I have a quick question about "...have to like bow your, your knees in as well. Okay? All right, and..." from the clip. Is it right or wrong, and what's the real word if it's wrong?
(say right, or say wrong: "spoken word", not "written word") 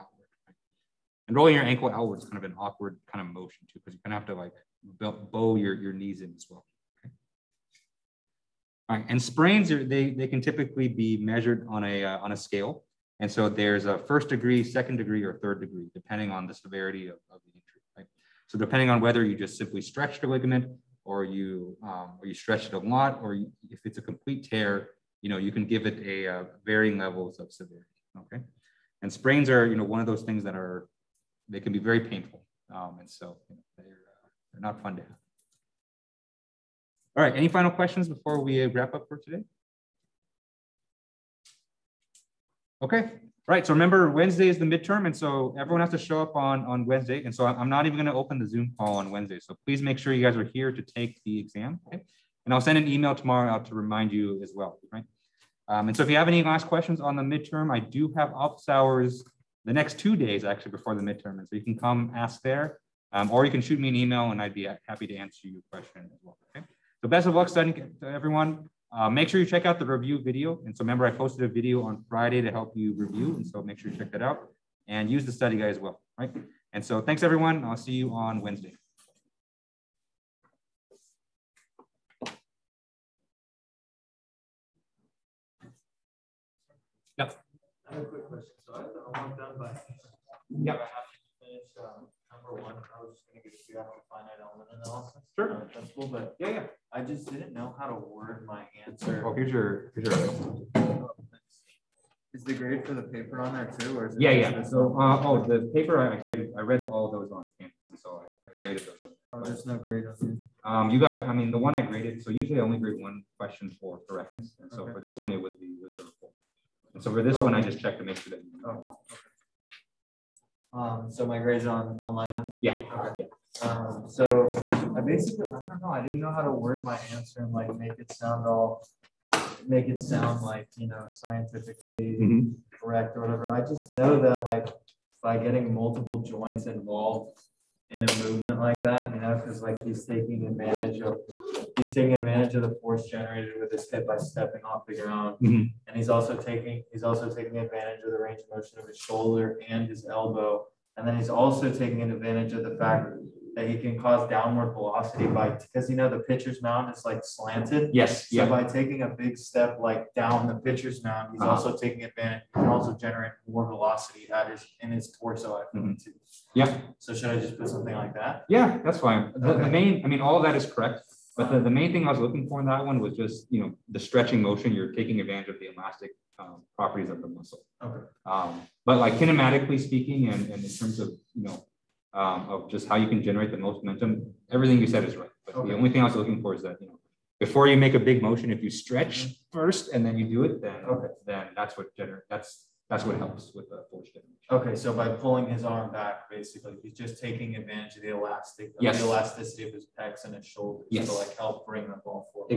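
right.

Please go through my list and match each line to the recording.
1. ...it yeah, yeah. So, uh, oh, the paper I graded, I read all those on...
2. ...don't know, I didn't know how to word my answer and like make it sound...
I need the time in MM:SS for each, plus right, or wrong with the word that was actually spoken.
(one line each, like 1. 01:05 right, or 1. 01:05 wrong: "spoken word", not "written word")
1. 01:44 right
2. 02:05 right.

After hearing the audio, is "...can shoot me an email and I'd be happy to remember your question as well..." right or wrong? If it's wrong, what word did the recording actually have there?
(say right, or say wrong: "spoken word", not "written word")
wrong: "answer", not "remember".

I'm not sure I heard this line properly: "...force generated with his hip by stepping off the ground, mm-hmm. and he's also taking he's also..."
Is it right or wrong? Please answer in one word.
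right.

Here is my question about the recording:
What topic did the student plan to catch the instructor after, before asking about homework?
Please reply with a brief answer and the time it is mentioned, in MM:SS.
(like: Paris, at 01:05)
finite element analysis, at 01:34.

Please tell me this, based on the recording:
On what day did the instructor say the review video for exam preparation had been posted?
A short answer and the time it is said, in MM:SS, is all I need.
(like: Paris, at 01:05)
Friday, at 01:12.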